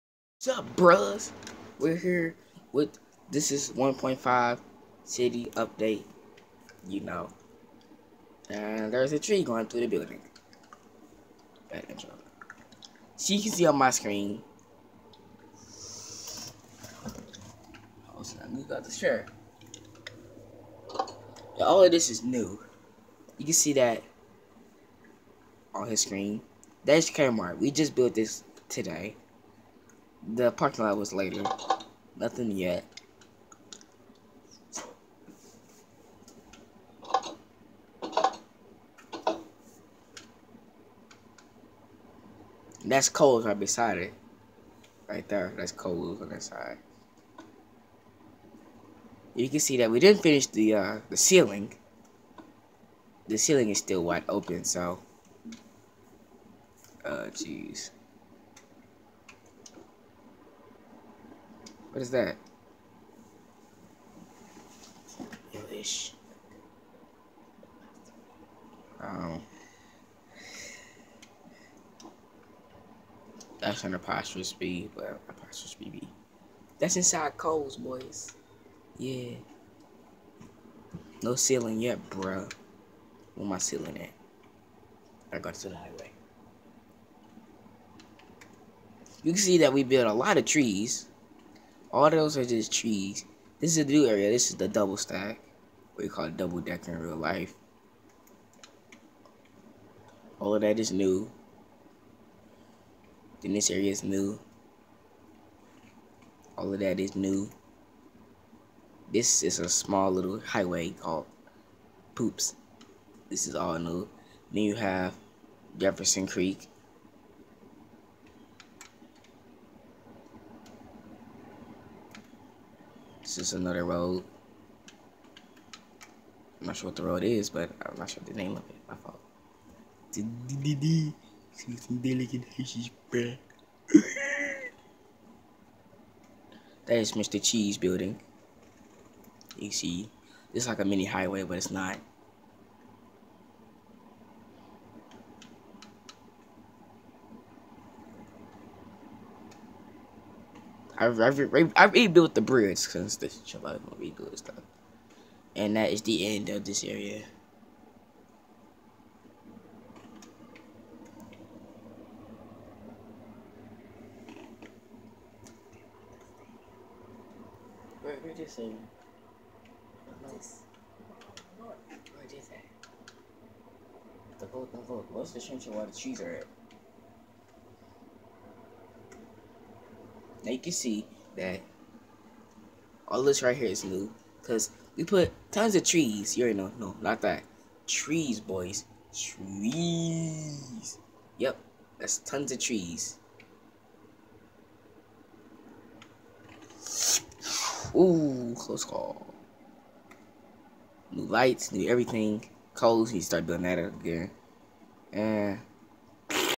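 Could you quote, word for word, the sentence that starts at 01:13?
That's an apostrophe B, but apostrophe B.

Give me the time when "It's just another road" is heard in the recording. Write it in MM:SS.
02:03.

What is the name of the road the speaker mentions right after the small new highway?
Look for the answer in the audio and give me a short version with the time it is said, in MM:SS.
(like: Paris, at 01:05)
Jefferson Creek, at 01:55.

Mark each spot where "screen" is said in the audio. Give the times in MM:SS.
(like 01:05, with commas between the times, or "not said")
00:13, 00:26.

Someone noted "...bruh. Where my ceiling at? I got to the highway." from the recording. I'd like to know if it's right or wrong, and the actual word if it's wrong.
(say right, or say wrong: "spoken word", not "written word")
right.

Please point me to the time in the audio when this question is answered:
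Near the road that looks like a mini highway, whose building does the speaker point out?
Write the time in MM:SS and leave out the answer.
02:17.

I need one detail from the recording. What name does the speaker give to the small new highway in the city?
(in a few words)
Poops.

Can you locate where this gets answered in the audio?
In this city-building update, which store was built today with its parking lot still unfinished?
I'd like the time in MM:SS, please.
00:27.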